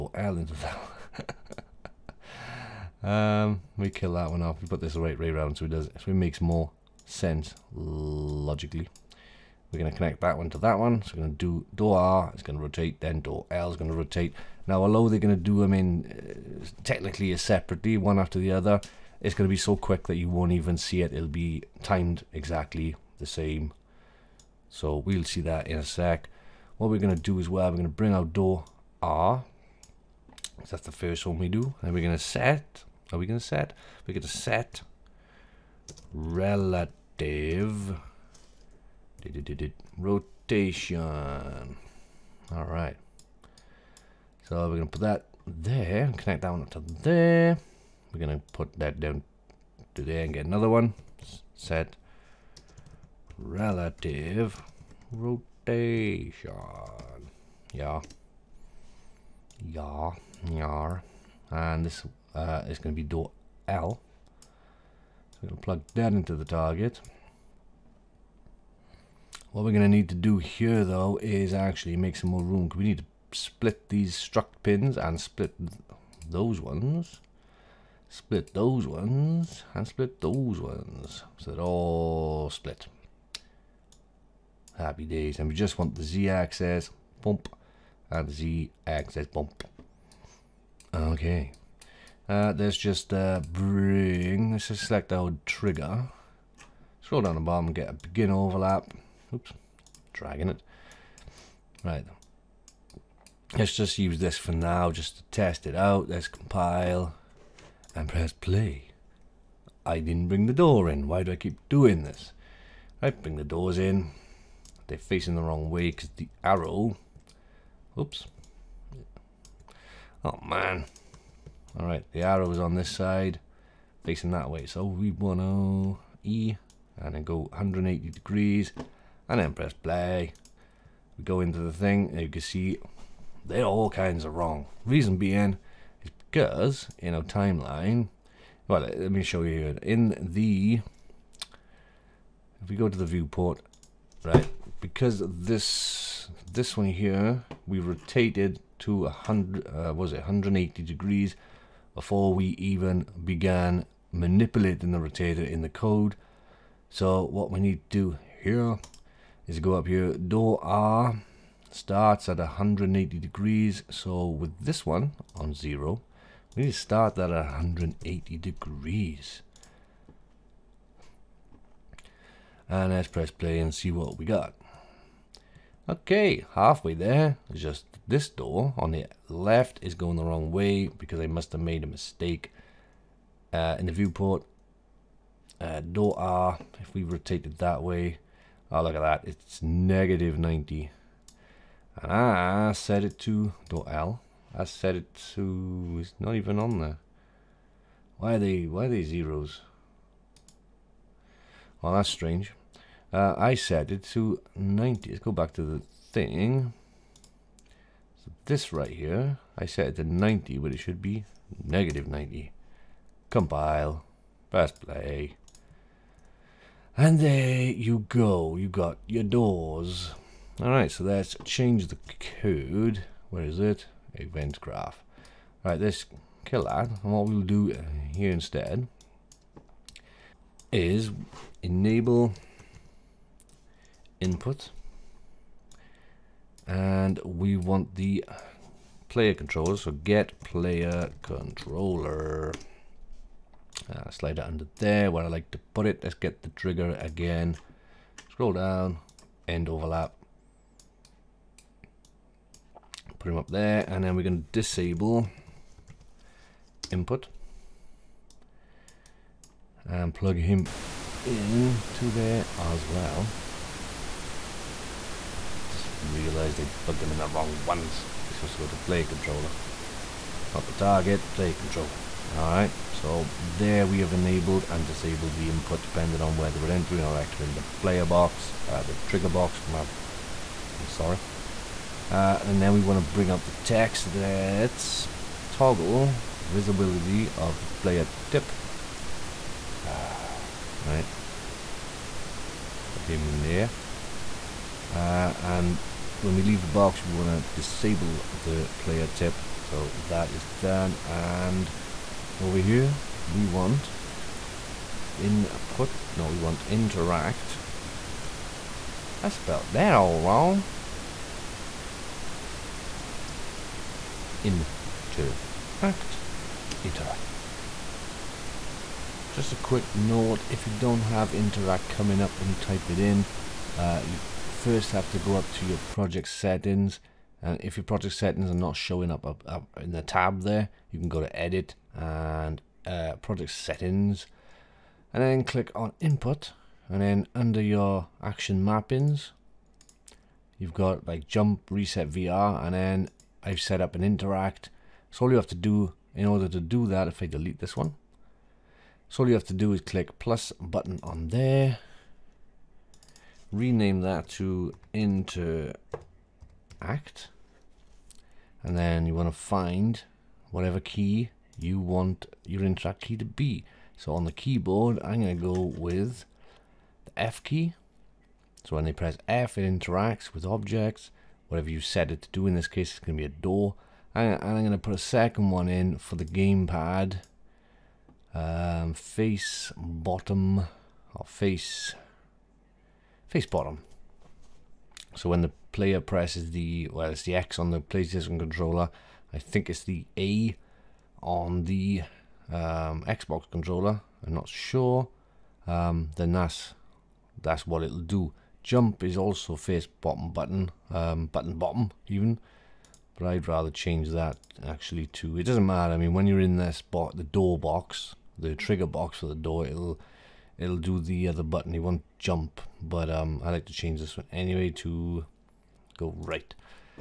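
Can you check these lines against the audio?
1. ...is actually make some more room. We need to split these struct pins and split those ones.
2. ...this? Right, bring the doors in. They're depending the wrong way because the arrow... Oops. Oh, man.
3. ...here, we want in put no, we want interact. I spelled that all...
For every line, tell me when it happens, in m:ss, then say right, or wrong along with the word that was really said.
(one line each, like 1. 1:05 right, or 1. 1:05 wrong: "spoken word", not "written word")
1. 1:11 right
2. 1:52 wrong: "facing", not "depending"
3. 5:02 right.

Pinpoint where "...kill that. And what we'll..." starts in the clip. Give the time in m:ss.
3:46.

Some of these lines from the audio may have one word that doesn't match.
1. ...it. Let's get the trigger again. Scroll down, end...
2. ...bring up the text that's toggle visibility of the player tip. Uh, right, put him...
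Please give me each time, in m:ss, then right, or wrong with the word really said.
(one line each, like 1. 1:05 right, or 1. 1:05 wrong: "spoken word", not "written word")
1. 4:05 right
2. 4:43 right.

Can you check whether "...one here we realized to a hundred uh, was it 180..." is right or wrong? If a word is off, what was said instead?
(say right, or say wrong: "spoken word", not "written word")
wrong: "rotated", not "realized".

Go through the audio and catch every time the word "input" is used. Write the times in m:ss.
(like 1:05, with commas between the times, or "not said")
3:54, 4:16, 4:35, 5:36.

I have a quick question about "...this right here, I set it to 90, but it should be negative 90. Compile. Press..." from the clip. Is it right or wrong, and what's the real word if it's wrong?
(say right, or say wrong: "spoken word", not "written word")
right.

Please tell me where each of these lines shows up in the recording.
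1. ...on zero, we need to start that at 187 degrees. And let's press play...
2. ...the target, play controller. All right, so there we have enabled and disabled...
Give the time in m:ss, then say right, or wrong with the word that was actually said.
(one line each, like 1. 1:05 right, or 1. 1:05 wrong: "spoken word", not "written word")
1. 2:45 wrong: "180", not "187"
2. 4:30 right.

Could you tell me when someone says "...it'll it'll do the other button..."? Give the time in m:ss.
6:49.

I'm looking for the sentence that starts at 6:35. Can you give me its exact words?
Um, then that's that's what it'll do.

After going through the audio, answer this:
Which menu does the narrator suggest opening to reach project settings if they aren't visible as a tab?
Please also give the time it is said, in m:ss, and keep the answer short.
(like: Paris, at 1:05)
Edit, at 5:31.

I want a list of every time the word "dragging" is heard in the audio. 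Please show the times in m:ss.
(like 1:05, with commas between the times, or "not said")
1:40.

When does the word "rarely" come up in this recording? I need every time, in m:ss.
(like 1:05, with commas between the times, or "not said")
not said.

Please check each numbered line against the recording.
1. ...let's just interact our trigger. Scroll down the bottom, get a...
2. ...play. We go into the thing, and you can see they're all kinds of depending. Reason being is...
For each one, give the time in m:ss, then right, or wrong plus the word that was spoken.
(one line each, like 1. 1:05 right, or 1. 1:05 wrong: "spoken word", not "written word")
1. 1:34 wrong: "select", not "interact"
2. 2:09 wrong: "wrong", not "depending".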